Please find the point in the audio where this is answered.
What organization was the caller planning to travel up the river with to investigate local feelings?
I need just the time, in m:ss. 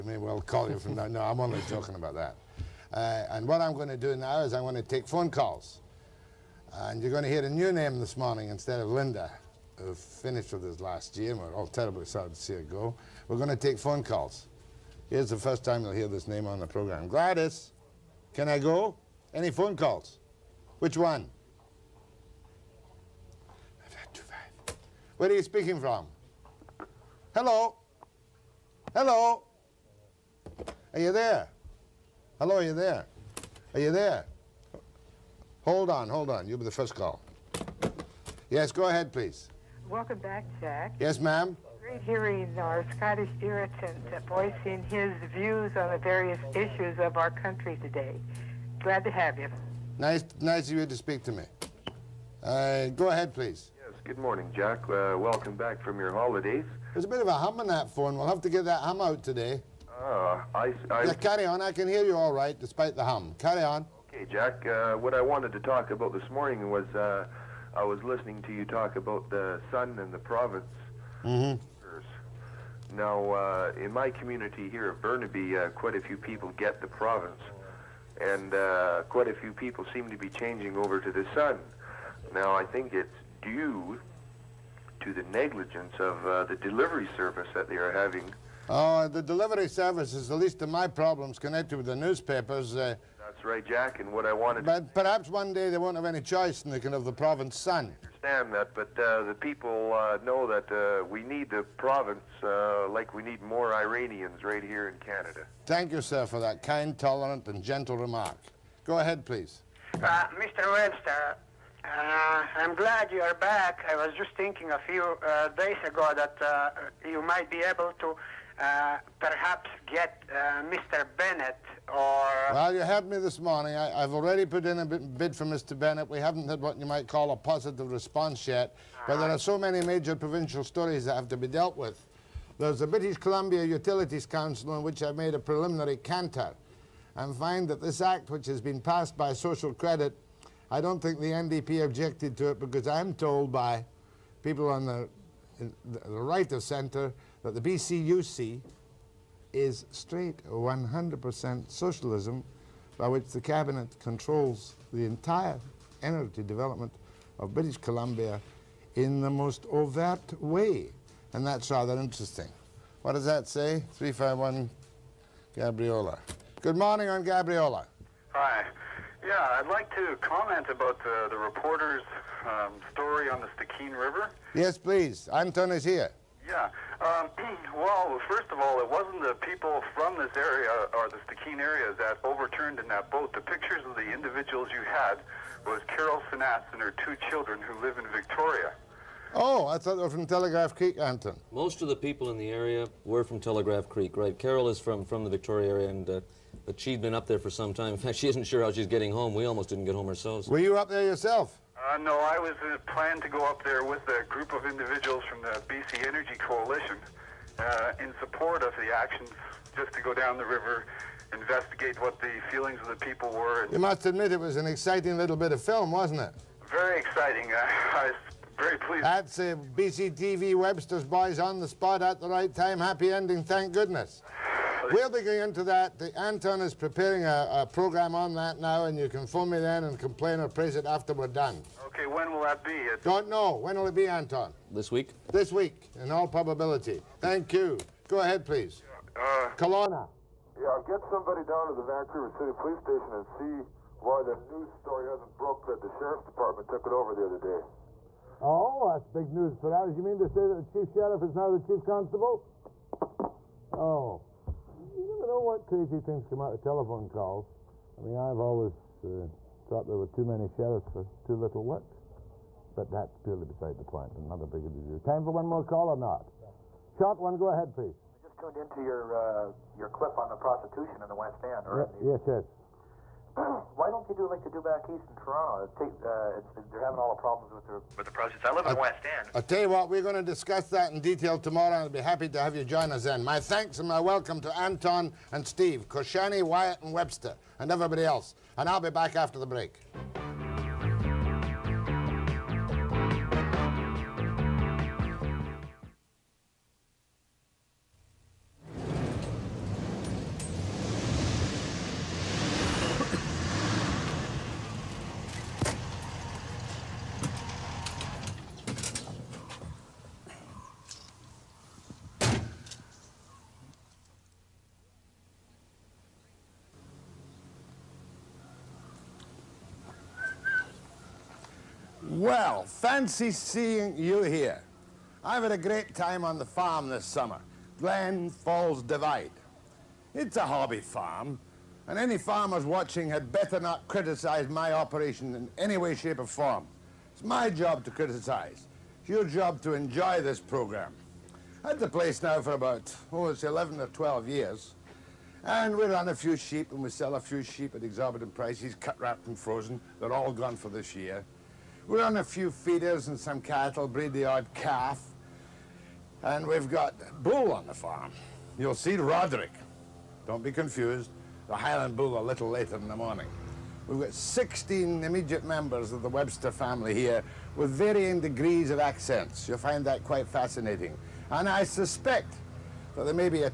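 3:25.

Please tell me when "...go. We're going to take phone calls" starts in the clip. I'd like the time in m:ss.
0:12.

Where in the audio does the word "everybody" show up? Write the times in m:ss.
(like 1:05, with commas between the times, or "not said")
4:47.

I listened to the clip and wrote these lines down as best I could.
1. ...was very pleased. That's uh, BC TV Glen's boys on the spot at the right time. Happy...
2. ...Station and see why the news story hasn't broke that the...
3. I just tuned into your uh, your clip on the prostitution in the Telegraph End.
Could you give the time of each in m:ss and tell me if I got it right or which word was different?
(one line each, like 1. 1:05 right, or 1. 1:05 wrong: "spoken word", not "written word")
1. 3:38 wrong: "Webster", not "Glen"
2. 4:02 right
3. 4:28 wrong: "West", not "Telegraph".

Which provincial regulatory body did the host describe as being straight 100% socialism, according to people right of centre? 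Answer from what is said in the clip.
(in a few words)
British Columbia Utilities Council.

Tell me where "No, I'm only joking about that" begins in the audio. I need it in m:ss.
0:01.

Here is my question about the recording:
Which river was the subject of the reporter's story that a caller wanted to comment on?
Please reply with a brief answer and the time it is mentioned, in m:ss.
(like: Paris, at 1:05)
Stikine River, at 2:53.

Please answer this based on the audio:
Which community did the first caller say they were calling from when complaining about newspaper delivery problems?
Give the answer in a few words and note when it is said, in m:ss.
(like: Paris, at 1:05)
Burnaby, at 1:15.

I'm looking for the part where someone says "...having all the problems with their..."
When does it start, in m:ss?
4:36.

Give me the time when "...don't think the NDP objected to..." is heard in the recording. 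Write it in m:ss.
2:20.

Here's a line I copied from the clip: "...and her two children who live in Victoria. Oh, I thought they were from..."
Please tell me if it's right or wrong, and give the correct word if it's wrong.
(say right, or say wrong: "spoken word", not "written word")
right.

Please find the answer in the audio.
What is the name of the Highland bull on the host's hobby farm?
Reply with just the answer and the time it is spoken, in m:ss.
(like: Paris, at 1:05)
Roderick, at 5:58.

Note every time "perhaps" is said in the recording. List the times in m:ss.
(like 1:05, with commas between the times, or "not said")
1:34, 1:59.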